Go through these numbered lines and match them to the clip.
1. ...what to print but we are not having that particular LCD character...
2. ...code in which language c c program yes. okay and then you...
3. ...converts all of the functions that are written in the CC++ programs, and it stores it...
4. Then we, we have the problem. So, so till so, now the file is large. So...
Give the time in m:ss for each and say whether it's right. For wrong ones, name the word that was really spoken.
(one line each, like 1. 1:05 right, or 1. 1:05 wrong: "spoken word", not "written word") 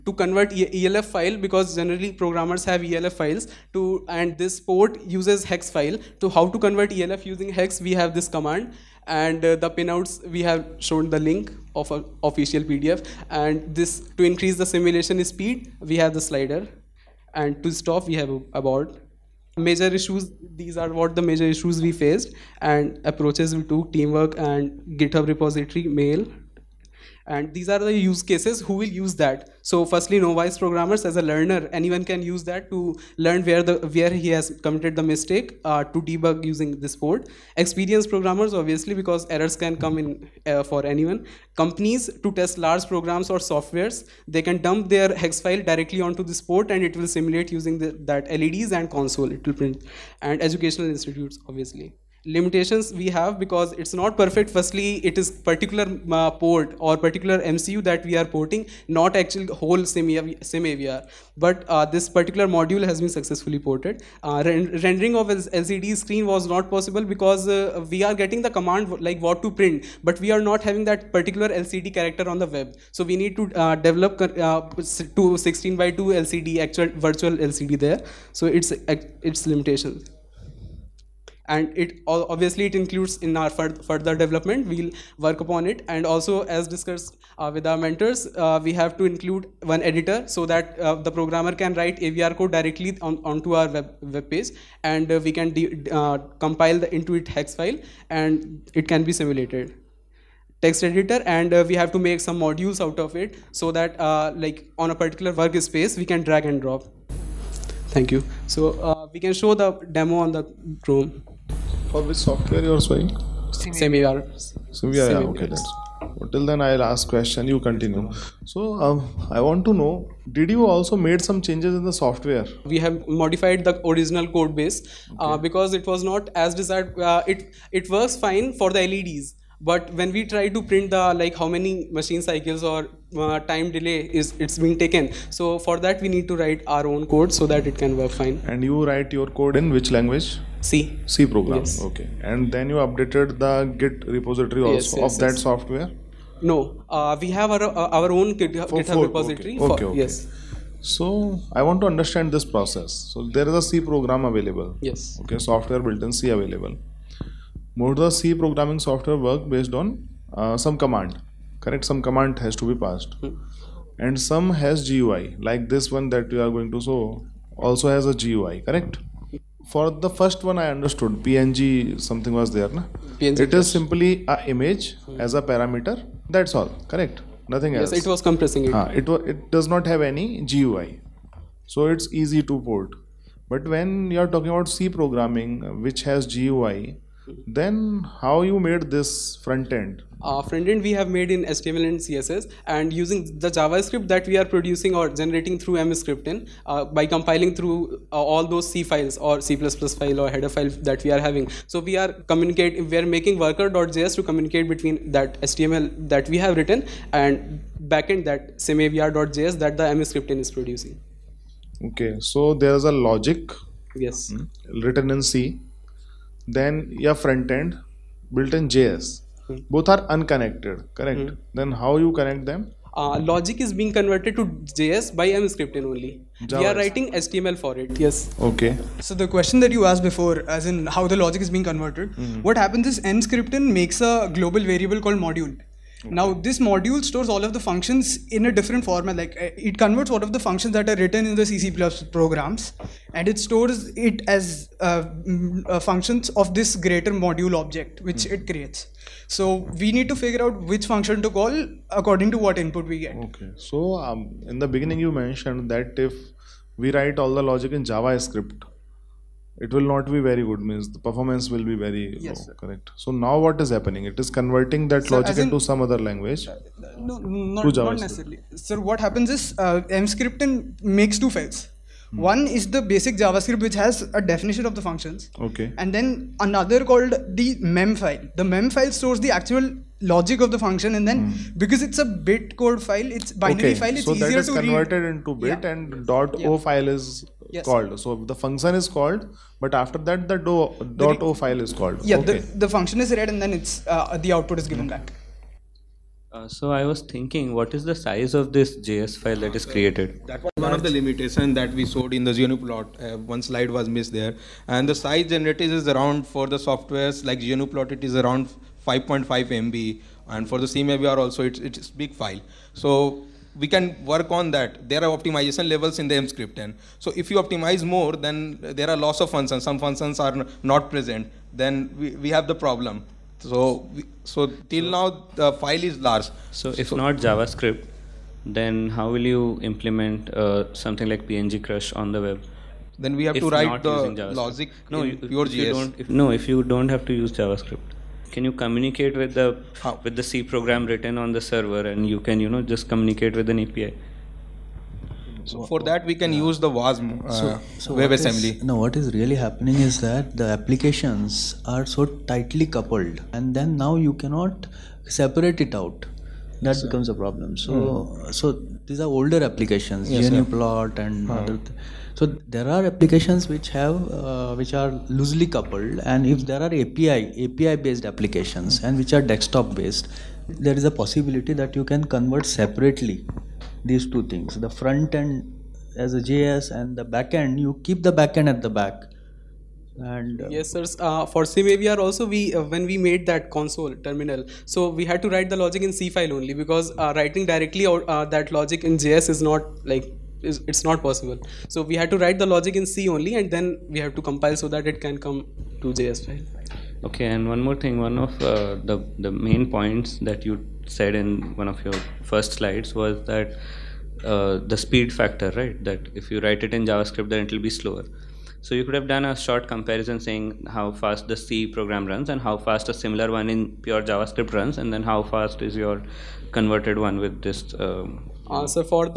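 1. 1:09 right
2. 2:19 right
3. 3:59 right
4. 5:21 right.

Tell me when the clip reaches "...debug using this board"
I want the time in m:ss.
0:36.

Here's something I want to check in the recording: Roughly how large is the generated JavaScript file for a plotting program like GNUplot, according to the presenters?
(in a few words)
5.5 MB.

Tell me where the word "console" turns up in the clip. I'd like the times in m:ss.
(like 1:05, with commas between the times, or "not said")
0:48, 6:23.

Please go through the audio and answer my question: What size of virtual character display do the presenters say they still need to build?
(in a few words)
16 by 2.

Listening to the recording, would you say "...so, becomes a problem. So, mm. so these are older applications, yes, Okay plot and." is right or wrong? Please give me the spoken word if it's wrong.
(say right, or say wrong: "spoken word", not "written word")
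wrong: "GNU", not "Okay".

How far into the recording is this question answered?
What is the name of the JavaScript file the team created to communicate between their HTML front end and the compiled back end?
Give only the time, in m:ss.
3:23.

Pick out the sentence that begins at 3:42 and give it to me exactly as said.
Uh, logic is being converted to JS by Emscripten only.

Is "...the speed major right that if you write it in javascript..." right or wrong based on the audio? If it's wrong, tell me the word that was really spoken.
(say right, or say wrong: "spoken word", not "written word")
wrong: "factor", not "major".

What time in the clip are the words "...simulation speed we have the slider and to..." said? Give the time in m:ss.
0:14.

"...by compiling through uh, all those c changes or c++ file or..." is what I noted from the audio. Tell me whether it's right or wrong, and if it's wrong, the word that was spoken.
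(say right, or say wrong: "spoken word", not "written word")
wrong: "files", not "changes".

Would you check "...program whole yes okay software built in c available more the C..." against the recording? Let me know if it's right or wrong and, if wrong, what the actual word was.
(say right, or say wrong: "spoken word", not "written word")
wrong: "available", not "whole".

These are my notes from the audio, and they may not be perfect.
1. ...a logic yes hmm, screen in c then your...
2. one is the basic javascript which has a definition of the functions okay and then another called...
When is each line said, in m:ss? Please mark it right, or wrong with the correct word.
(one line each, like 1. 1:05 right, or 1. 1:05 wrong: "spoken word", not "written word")
1. 3:32 wrong: "written", not "screen"
2. 4:32 right.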